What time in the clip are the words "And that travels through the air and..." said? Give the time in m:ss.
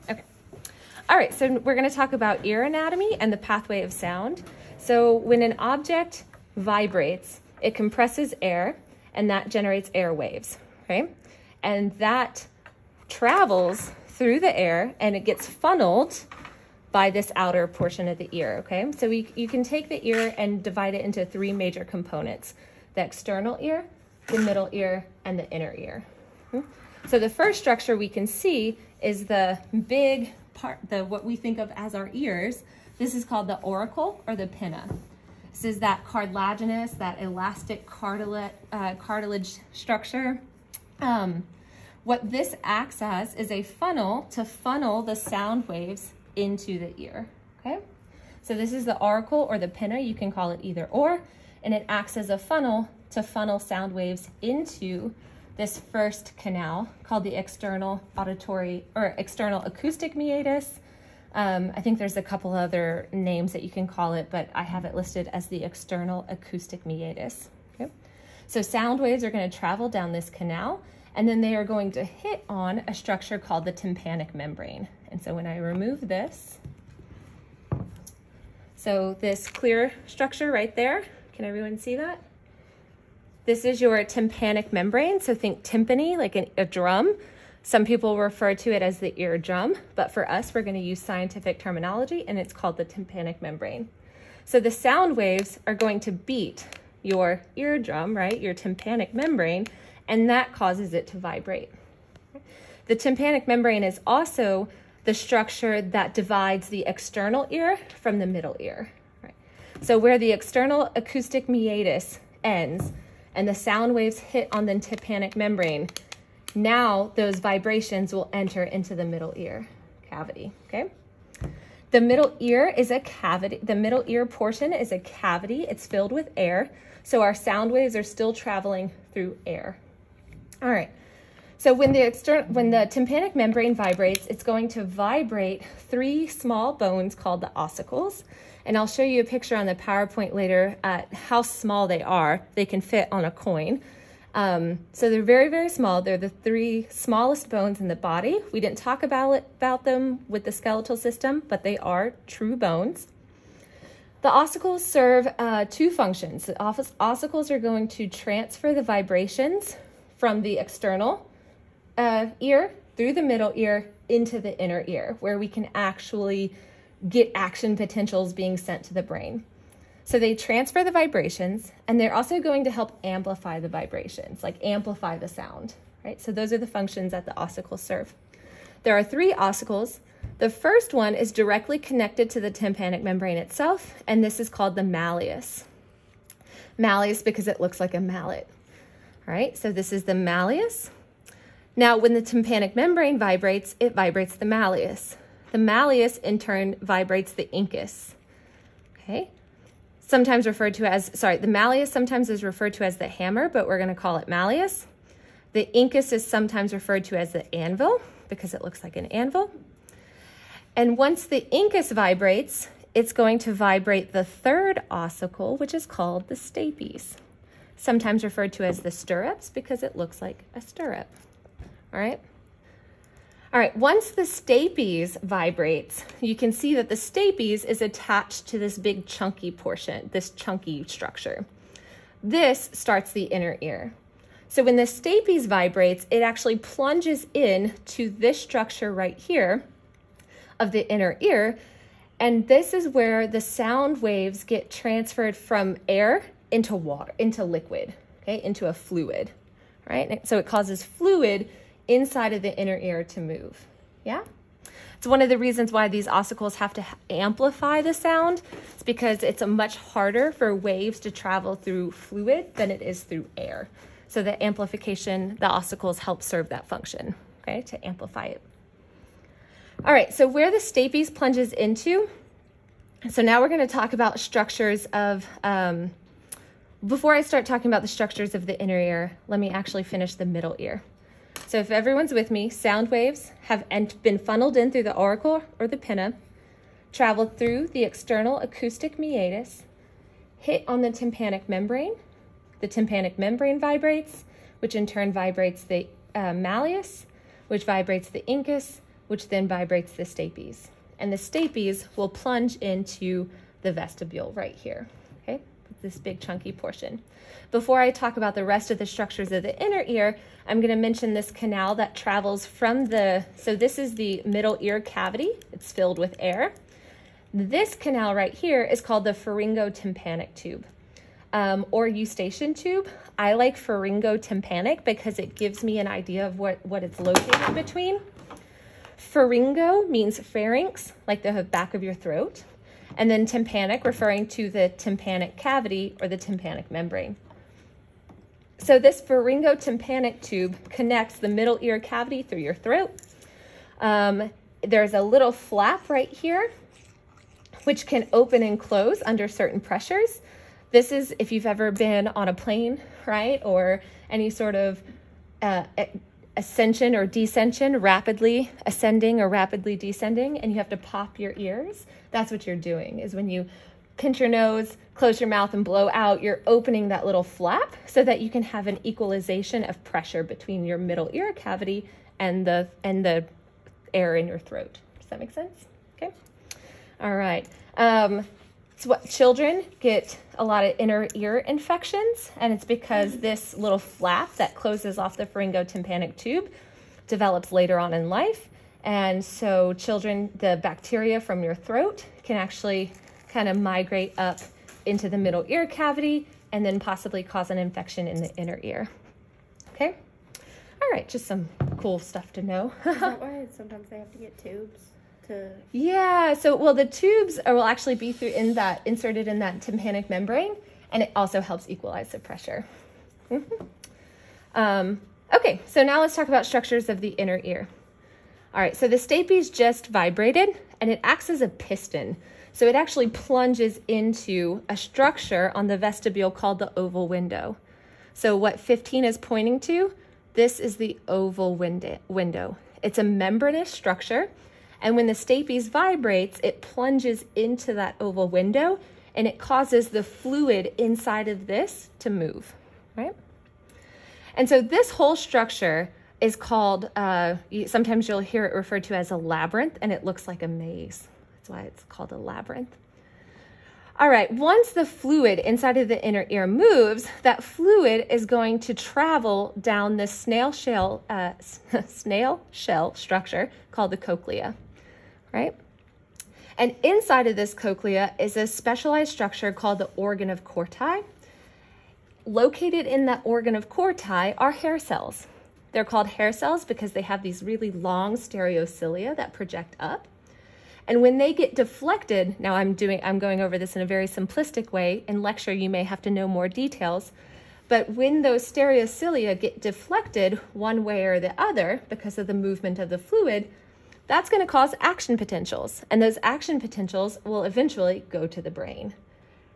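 0:11.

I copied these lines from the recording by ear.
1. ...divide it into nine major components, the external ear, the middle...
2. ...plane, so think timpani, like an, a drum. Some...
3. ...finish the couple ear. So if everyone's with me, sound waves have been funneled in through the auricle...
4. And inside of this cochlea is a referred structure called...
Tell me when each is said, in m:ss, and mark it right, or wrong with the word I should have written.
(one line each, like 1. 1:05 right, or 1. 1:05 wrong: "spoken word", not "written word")
1. 0:20 wrong: "three", not "nine"
2. 1:24 wrong: "membrane", not "plane"
3. 4:39 wrong: "middle", not "couple"
4. 7:46 wrong: "specialized", not "referred".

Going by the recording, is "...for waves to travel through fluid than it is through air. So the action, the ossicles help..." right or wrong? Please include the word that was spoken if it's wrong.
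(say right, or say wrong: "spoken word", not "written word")
wrong: "amplification", not "action".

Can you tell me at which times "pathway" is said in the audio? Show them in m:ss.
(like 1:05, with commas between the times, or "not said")
0:03.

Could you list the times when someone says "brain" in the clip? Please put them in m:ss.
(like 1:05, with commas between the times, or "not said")
2:49, 8:18.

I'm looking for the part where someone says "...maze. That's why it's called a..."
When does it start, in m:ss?
7:30.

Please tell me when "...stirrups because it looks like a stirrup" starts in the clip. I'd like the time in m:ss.
3:38.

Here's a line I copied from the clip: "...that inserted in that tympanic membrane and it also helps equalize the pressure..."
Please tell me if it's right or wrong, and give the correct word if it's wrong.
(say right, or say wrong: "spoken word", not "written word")
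right.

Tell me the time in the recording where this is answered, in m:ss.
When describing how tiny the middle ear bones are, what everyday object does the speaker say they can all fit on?
2:23.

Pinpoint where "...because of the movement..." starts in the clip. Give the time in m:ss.
8:11.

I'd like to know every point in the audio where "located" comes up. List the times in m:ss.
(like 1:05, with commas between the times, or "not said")
5:26, 7:52.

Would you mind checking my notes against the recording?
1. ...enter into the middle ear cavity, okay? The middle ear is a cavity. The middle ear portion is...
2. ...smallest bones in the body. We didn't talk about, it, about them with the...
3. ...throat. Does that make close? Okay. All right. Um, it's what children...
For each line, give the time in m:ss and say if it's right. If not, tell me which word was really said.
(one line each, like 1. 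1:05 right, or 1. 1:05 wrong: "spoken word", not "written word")
1. 1:58 right
2. 2:26 right
3. 6:14 wrong: "sense", not "close".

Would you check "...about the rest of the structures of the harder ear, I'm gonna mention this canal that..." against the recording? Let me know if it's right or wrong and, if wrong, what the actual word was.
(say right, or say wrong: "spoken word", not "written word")
wrong: "inner", not "harder".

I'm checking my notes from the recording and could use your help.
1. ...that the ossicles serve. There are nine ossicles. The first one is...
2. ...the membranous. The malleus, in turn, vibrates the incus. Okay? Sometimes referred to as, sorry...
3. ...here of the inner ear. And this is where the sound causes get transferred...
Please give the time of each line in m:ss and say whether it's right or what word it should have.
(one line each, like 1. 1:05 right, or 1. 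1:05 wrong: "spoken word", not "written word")
1. 2:57 wrong: "three", not "nine"
2. 3:14 wrong: "malleus", not "membranous"
3. 3:59 wrong: "waves", not "causes".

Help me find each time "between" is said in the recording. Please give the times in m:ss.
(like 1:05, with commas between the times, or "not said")
5:27, 6:10.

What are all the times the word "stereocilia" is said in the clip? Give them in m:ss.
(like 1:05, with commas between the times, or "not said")
7:58, 8:08.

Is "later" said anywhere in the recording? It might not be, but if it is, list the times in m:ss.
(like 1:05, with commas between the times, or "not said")
2:20, 6:27.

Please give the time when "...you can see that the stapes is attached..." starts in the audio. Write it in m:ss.
3:46.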